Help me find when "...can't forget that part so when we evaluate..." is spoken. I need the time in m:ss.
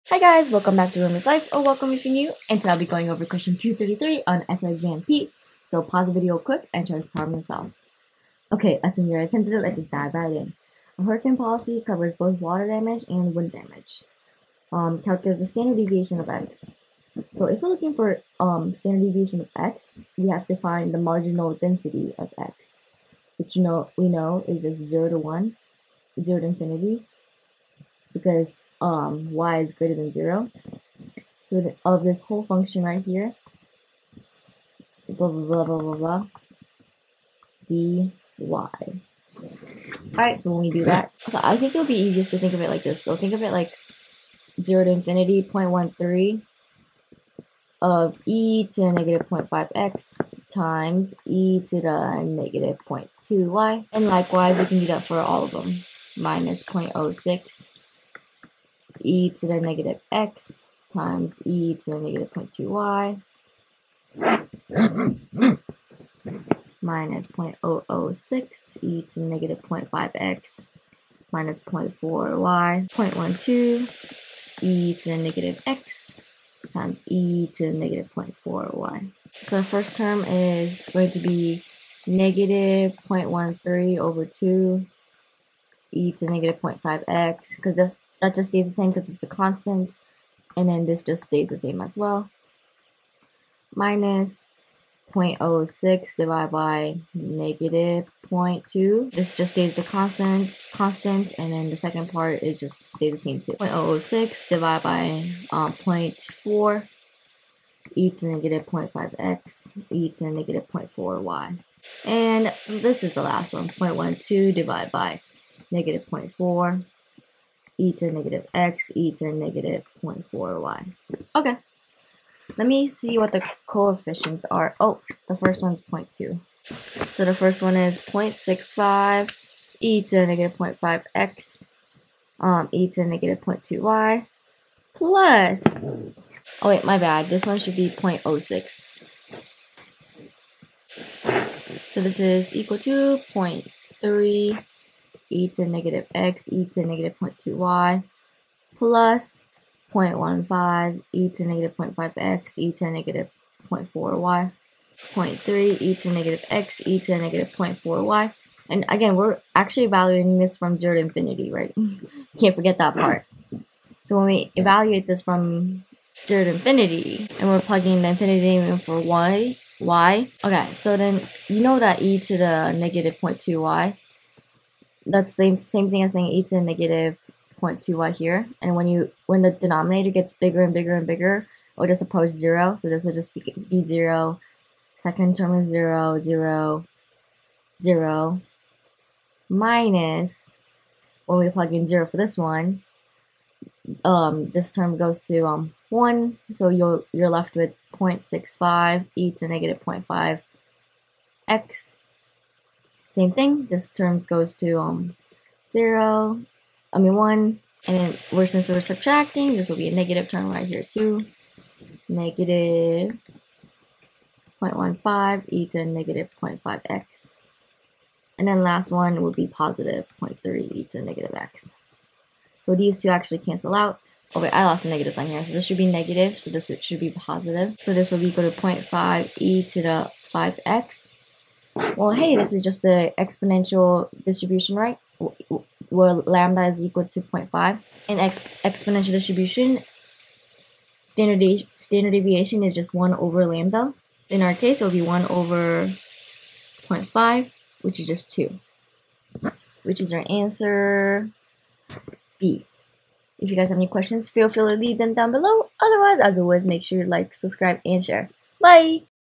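2:42.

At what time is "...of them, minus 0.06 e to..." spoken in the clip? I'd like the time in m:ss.
0:55.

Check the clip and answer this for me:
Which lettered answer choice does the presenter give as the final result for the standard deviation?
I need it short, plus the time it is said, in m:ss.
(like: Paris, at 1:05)
B, at 4:10.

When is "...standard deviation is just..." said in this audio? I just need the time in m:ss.
4:01.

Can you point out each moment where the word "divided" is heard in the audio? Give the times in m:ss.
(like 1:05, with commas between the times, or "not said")
1:36, 1:44, 1:54.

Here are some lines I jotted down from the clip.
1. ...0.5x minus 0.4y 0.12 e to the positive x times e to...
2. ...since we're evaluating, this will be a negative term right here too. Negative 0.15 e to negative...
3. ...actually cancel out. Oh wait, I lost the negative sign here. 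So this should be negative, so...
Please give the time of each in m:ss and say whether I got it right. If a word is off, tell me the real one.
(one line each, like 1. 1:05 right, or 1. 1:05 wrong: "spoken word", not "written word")
1. 1:09 wrong: "negative", not "positive"
2. 3:28 wrong: "subtracting", not "evaluating"
3. 3:43 right.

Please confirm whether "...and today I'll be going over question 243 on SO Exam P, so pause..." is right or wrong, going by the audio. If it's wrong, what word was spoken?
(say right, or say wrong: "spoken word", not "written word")
wrong: "233", not "243".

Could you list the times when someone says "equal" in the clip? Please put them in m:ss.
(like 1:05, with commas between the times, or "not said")
2:22, 3:48, 3:56.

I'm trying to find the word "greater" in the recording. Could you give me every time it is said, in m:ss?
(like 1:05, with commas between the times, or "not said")
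0:29.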